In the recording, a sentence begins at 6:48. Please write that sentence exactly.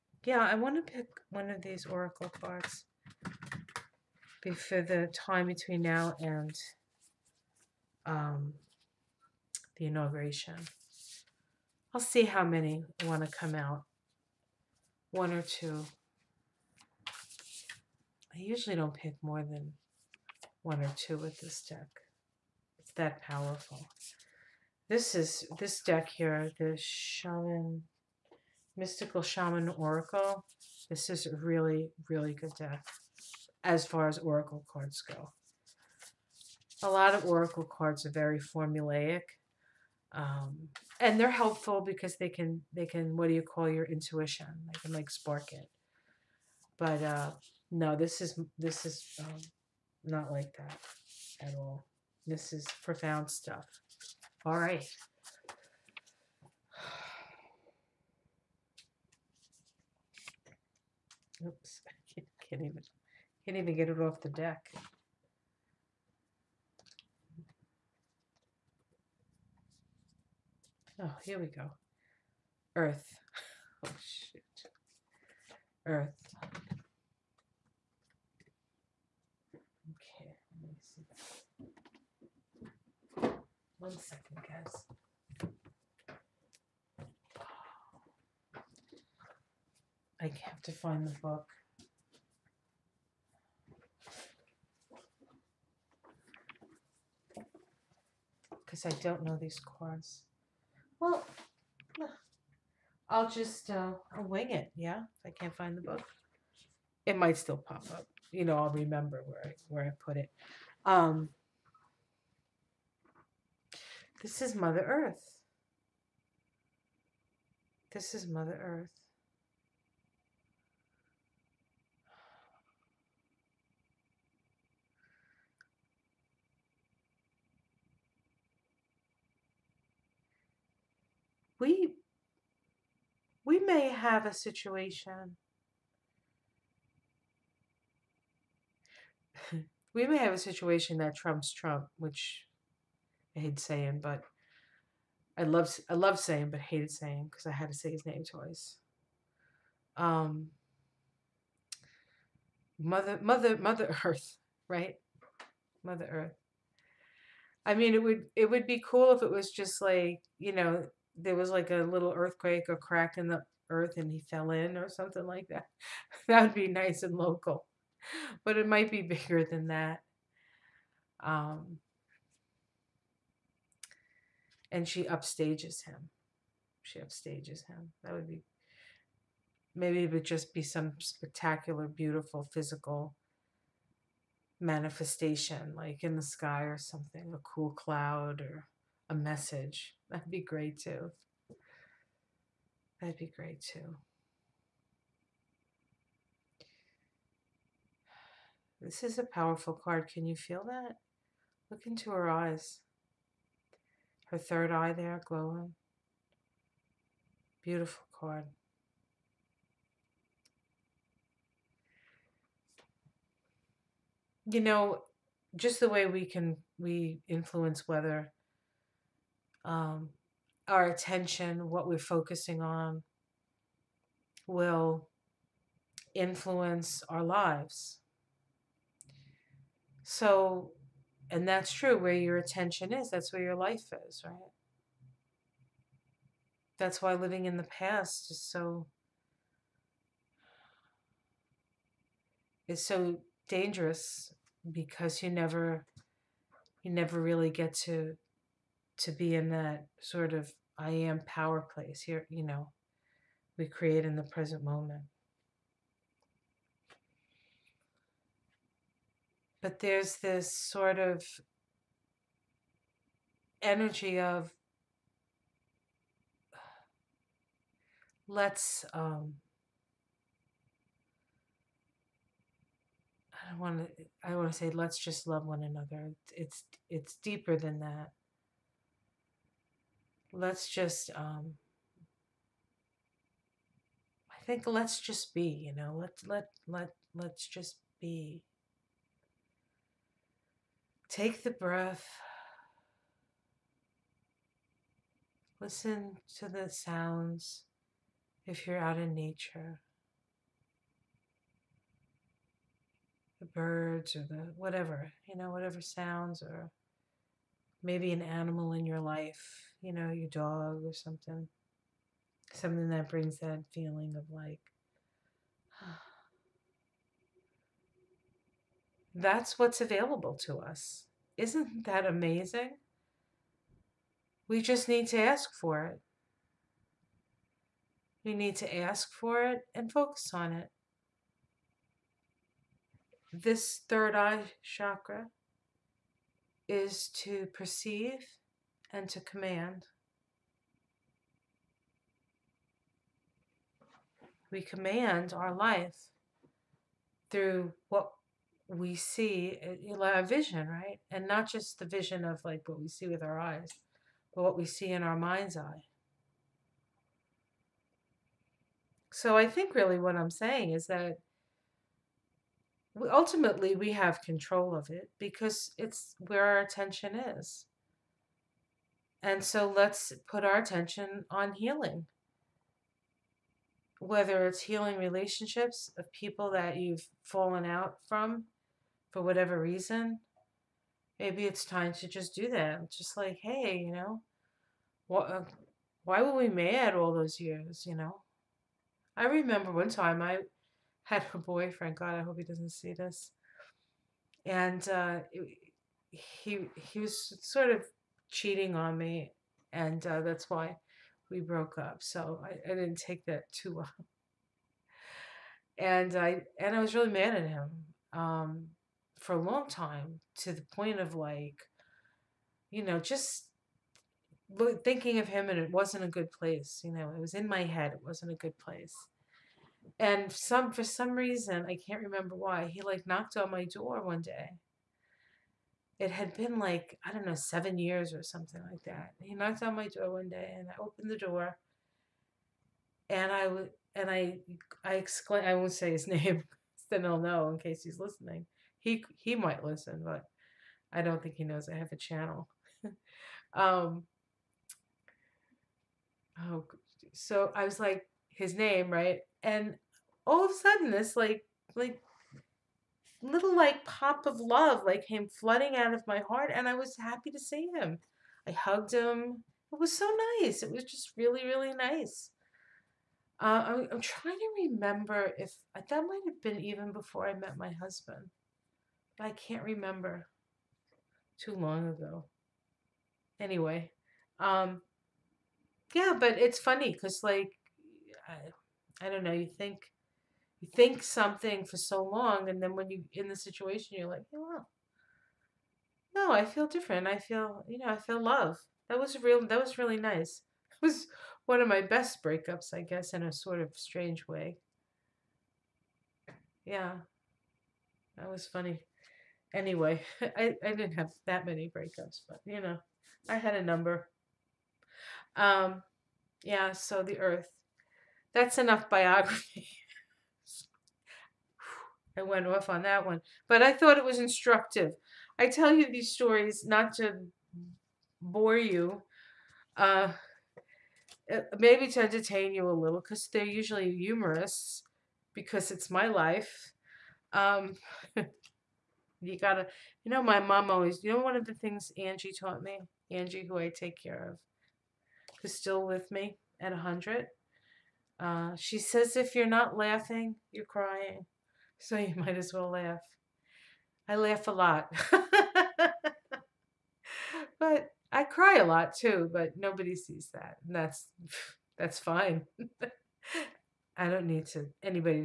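Um, for a long time to the point of like, you know, just thinking of him and it wasn't a good place.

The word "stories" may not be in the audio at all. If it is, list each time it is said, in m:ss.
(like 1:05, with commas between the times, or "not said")
8:36.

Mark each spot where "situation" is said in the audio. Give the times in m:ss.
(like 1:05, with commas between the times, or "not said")
2:14, 2:20, 8:03.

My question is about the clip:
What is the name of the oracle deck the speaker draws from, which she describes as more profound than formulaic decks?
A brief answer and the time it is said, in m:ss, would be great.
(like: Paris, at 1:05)
Mystical Shaman Oracle, at 0:28.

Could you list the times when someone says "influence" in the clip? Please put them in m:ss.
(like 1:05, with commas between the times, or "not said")
3:37, 3:46.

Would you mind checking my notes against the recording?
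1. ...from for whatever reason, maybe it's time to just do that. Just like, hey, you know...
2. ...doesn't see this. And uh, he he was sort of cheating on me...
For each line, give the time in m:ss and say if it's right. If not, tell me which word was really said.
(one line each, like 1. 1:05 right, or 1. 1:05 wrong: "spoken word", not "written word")
1. 6:18 right
2. 6:32 right.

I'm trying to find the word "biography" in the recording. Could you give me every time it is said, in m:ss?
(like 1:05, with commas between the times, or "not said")
8:28.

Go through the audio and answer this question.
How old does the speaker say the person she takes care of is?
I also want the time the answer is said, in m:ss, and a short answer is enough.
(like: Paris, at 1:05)
100, at 8:56.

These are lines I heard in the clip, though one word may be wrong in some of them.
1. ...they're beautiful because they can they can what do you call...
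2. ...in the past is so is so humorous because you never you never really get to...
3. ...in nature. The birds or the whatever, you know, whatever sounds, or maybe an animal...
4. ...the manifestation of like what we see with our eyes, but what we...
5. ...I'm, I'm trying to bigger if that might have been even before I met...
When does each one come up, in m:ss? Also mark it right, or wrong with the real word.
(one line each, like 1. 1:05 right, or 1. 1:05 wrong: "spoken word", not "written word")
1. 0:41 wrong: "helpful", not "beautiful"
2. 3:57 wrong: "dangerous", not "humorous"
3. 4:58 right
4. 5:51 wrong: "vision", not "manifestation"
5. 7:43 wrong: "remember", not "bigger".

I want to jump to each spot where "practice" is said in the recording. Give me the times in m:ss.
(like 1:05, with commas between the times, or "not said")
not said.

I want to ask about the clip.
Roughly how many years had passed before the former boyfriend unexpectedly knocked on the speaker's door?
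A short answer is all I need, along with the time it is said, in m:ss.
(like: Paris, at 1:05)
7, at 7:07.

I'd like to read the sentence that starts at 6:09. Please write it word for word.
And so let's put our attention on healing.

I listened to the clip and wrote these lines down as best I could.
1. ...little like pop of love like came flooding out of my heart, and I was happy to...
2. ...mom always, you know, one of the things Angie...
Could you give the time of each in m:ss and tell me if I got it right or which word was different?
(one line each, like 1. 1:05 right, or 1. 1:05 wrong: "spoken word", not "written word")
1. 7:33 right
2. 8:50 right.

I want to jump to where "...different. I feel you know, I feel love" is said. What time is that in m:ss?
8:06.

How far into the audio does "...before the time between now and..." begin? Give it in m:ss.
0:04.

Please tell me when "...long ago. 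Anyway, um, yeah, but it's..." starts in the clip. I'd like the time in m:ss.
7:51.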